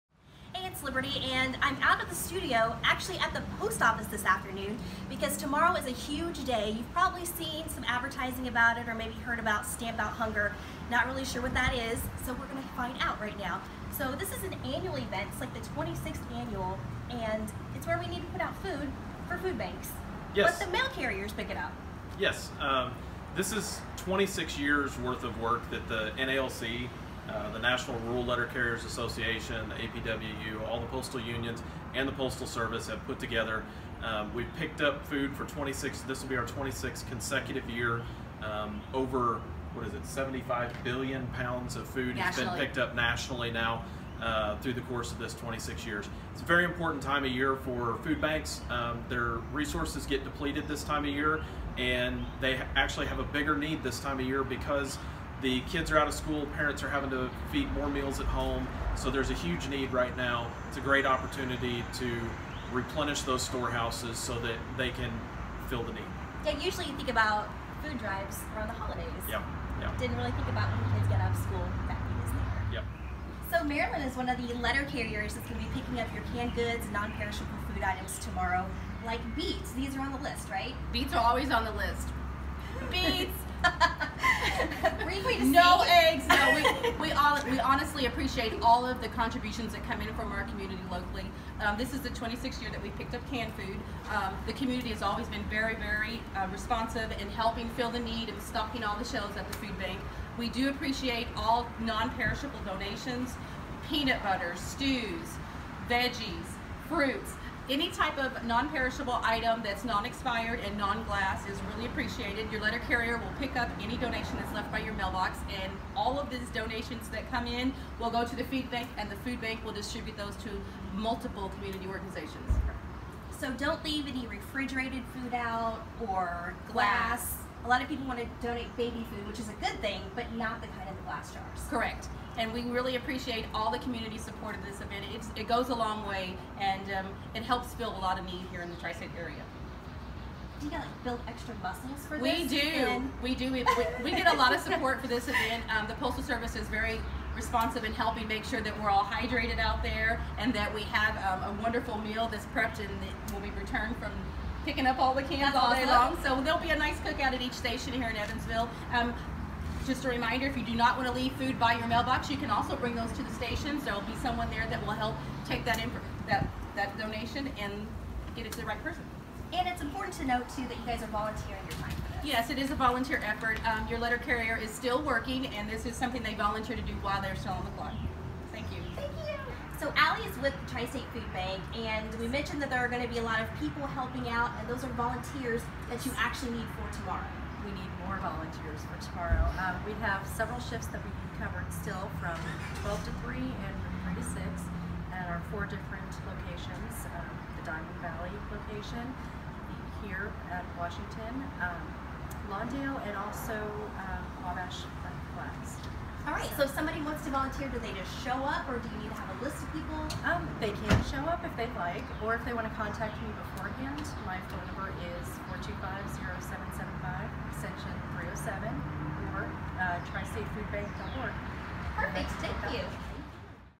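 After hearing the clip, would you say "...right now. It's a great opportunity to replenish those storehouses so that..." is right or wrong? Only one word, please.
right.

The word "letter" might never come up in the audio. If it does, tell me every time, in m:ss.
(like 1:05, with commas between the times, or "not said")
0:28, 1:14, 1:52, 2:53.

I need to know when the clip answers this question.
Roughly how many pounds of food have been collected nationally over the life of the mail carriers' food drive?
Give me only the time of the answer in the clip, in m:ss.
0:40.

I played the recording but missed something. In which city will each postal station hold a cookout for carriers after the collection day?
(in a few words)
Evansville.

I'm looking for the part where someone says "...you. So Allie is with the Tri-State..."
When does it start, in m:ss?
2:59.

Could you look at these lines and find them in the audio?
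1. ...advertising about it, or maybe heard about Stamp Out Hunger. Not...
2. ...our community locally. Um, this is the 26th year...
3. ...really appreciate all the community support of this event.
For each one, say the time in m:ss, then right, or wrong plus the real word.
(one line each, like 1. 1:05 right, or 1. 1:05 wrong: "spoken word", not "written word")
1. 0:07 right
2. 1:30 right
3. 2:12 right.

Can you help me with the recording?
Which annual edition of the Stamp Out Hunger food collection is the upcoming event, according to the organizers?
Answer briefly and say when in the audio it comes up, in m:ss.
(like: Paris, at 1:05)
26th, at 0:15.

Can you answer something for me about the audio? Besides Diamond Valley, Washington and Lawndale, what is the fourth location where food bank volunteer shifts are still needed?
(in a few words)
Wabash Flats.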